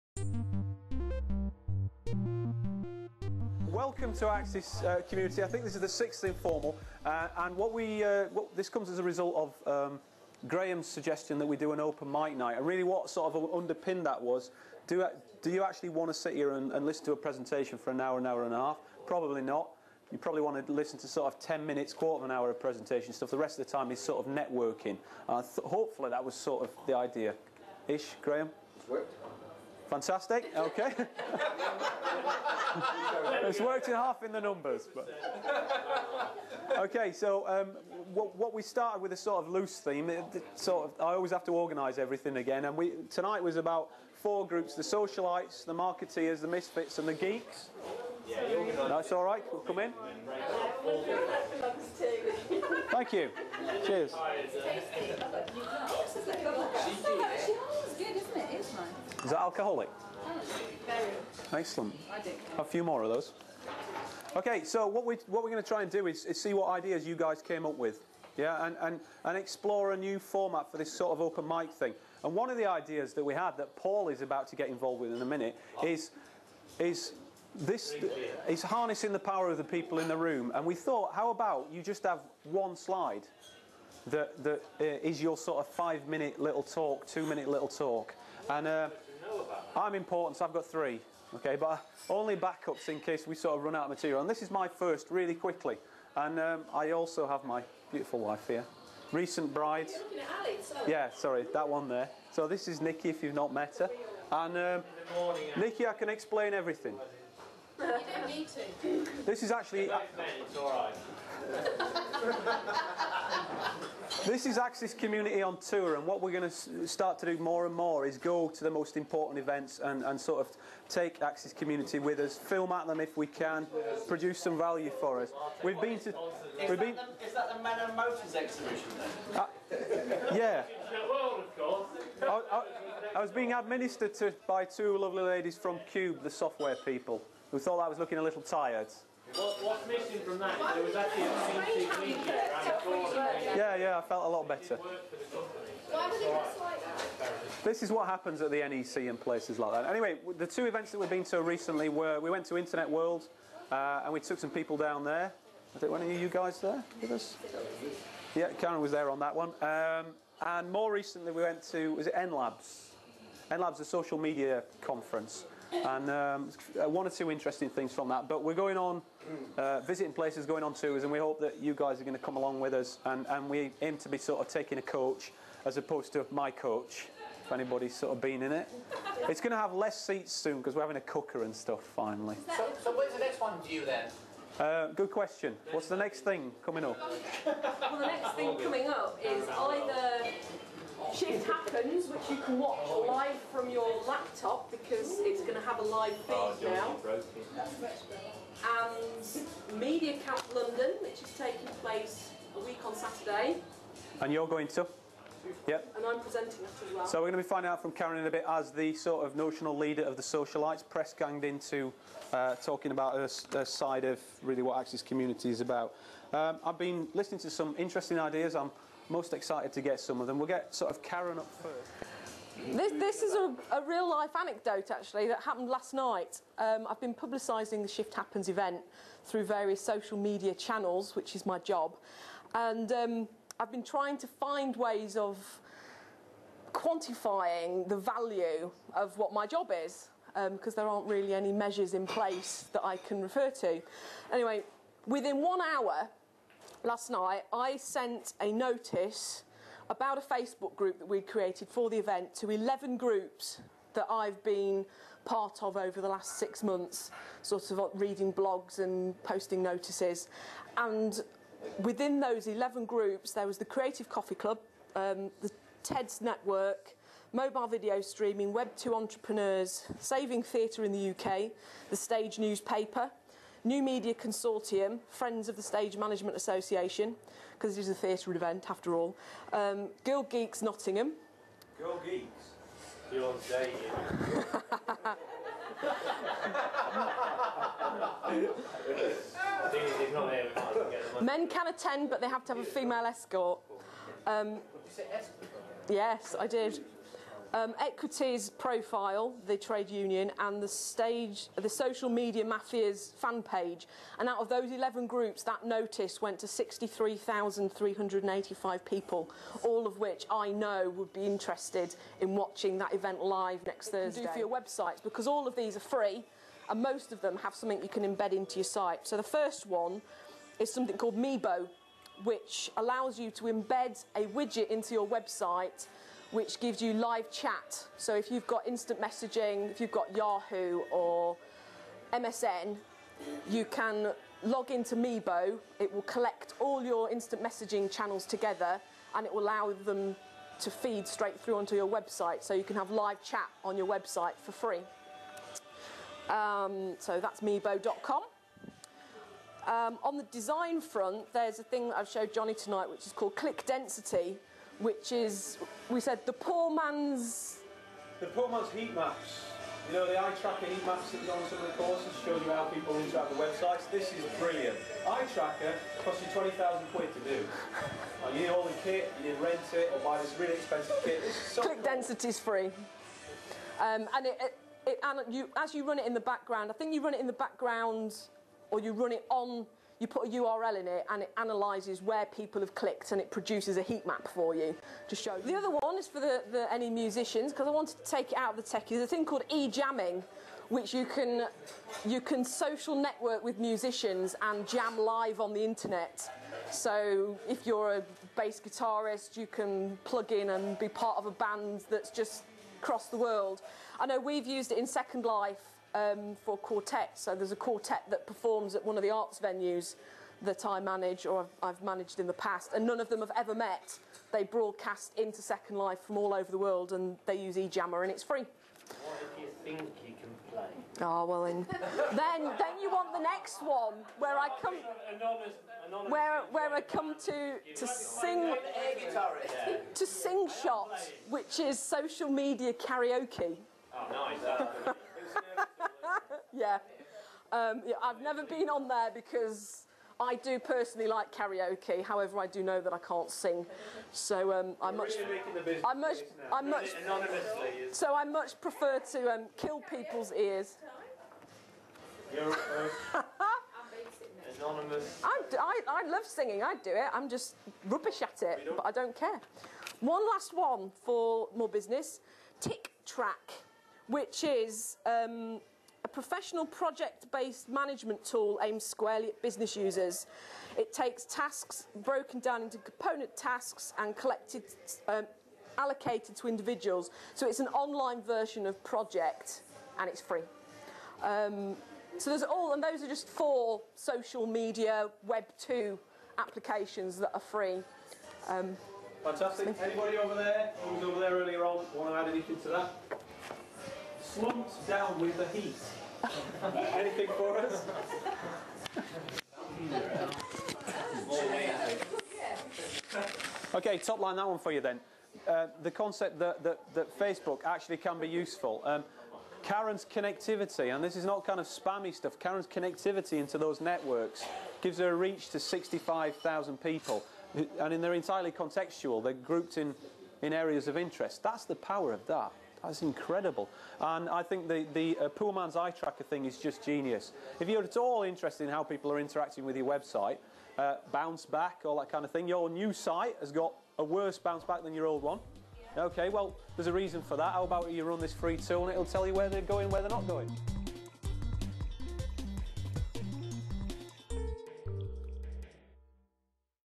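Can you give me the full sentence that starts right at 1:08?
Yeah, and, and, and explore a new format for this sort of open mic thing.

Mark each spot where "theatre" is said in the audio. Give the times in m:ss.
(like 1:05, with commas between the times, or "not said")
4:30, 4:37.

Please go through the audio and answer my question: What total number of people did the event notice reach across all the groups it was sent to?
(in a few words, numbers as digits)
63,385.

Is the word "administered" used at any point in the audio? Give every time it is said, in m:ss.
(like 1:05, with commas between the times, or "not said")
2:13.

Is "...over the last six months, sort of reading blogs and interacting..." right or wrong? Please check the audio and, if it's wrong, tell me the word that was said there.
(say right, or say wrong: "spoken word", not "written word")
wrong: "posting", not "interacting".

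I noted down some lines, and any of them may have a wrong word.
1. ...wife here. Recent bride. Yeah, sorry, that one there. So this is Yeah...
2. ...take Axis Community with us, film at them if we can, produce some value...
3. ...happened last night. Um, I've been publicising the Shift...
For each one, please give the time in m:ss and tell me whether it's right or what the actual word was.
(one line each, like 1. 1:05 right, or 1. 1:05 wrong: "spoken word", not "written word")
1. 1:38 wrong: "Nikki", not "Yeah"
2. 2:00 right
3. 3:45 right.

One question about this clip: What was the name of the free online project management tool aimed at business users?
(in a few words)
Tick track.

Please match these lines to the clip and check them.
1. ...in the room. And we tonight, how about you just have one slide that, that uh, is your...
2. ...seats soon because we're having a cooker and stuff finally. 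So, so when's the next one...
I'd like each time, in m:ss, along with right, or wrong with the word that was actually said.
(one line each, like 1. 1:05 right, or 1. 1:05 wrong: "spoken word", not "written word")
1. 1:19 wrong: "thought", not "tonight"
2. 3:00 right.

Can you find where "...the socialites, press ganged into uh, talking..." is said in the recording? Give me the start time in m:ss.
3:30.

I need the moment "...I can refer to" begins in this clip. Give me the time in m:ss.
4:02.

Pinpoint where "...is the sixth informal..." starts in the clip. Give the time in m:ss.
0:05.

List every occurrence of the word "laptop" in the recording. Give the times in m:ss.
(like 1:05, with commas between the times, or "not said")
3:14.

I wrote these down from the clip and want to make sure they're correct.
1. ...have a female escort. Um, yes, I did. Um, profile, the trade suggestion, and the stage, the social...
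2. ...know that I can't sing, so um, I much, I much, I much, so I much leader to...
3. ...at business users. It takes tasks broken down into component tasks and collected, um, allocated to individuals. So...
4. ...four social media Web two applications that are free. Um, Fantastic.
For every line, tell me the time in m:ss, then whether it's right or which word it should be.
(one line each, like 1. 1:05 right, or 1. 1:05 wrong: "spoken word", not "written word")
1. 4:52 wrong: "union", not "suggestion"
2. 7:22 wrong: "prefer", not "leader"
3. 7:49 right
4. 8:03 right.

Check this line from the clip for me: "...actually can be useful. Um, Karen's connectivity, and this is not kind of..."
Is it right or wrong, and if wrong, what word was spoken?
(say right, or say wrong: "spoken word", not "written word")
right.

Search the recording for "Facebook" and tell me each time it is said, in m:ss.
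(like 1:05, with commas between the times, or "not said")
4:10, 8:27.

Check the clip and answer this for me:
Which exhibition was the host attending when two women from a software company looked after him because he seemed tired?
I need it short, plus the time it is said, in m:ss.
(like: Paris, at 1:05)
Men and Motors, at 2:07.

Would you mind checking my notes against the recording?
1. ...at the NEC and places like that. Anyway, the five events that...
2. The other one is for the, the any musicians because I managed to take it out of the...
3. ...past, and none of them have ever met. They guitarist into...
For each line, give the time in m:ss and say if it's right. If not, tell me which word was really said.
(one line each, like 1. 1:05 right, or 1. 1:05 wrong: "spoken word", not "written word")
1. 2:28 wrong: "two", not "five"
2. 6:25 wrong: "wanted", not "managed"
3. 6:52 wrong: "broadcast", not "guitarist".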